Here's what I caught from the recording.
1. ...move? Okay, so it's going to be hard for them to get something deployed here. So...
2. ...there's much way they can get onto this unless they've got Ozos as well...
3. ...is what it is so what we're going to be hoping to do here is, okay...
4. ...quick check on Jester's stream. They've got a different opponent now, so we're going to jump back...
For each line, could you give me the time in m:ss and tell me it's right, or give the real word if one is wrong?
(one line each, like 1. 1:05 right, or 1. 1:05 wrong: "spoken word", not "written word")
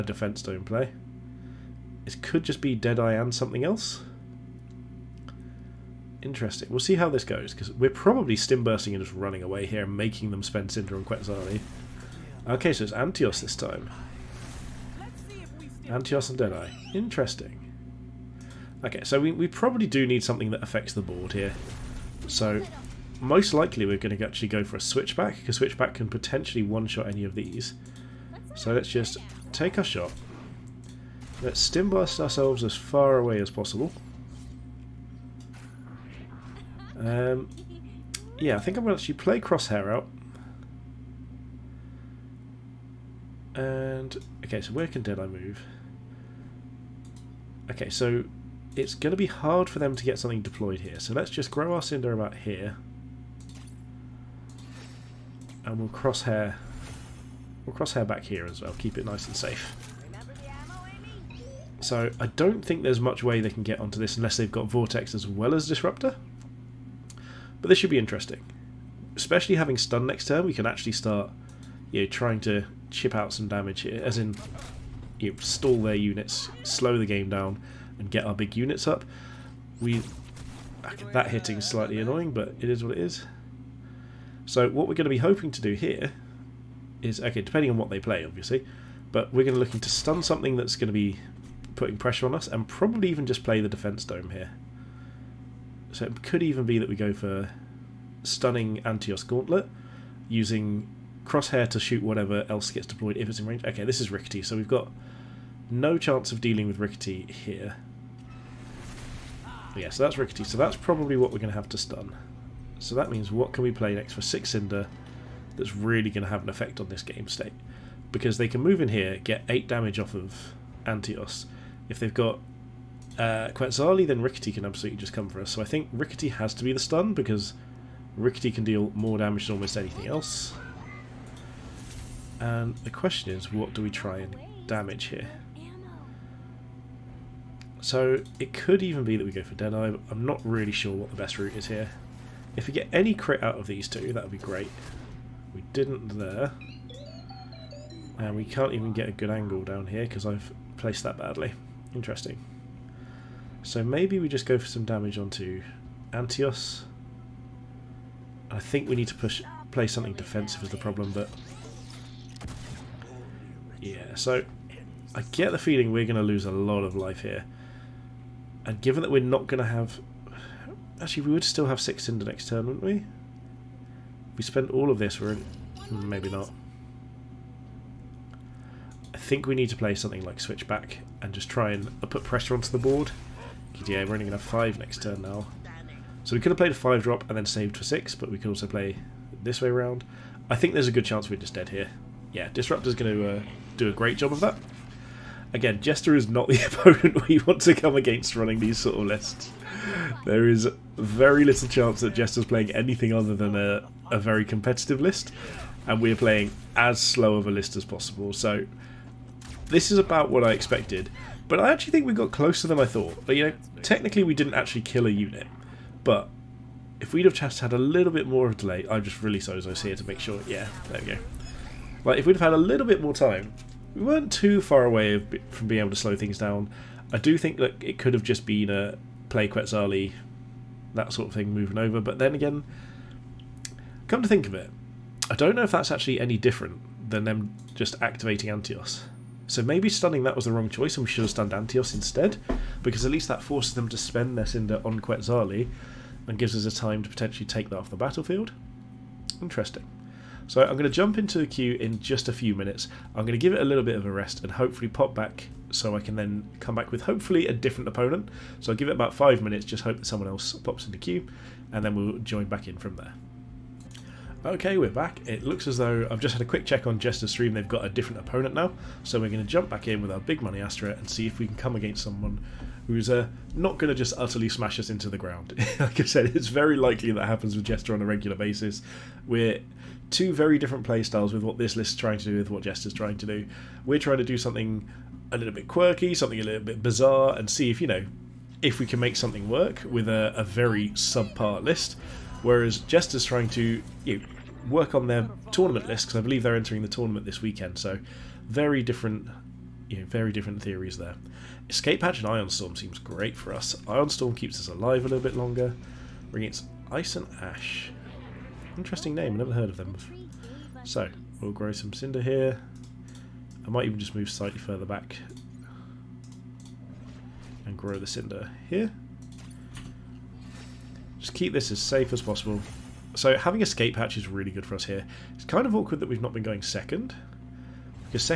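1. 0:45 right
2. 1:02 wrong: "Vortex", not "Ozos"
3. 1:22 right
4. 4:26 right.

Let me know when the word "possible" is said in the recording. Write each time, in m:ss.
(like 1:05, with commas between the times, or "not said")
0:33, 3:27, 5:22.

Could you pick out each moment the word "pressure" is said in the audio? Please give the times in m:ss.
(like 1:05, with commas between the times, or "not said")
1:31, 3:02.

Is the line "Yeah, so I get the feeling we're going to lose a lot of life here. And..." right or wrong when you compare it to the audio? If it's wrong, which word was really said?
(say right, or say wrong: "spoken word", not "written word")
right.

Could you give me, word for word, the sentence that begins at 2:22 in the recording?
If we get any crit out of these two, that would be great.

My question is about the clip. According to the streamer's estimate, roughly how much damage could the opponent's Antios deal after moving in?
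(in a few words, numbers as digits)
8.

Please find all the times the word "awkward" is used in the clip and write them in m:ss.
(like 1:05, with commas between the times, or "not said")
5:25.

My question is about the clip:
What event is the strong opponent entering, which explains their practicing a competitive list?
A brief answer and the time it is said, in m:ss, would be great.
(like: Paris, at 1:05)
tournament this weekend, at 4:56.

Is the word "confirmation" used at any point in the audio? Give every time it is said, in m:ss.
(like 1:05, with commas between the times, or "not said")
not said.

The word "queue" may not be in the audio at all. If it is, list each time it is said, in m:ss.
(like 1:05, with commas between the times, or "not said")
4:11, 4:20.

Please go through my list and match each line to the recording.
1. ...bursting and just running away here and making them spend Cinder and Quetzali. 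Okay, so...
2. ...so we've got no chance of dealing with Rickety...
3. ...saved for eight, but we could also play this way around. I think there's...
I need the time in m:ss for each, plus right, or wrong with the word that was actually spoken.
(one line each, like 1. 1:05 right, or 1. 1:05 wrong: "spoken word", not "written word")
1. 0:08 right
2. 1:44 right
3. 3:07 wrong: "six", not "eight".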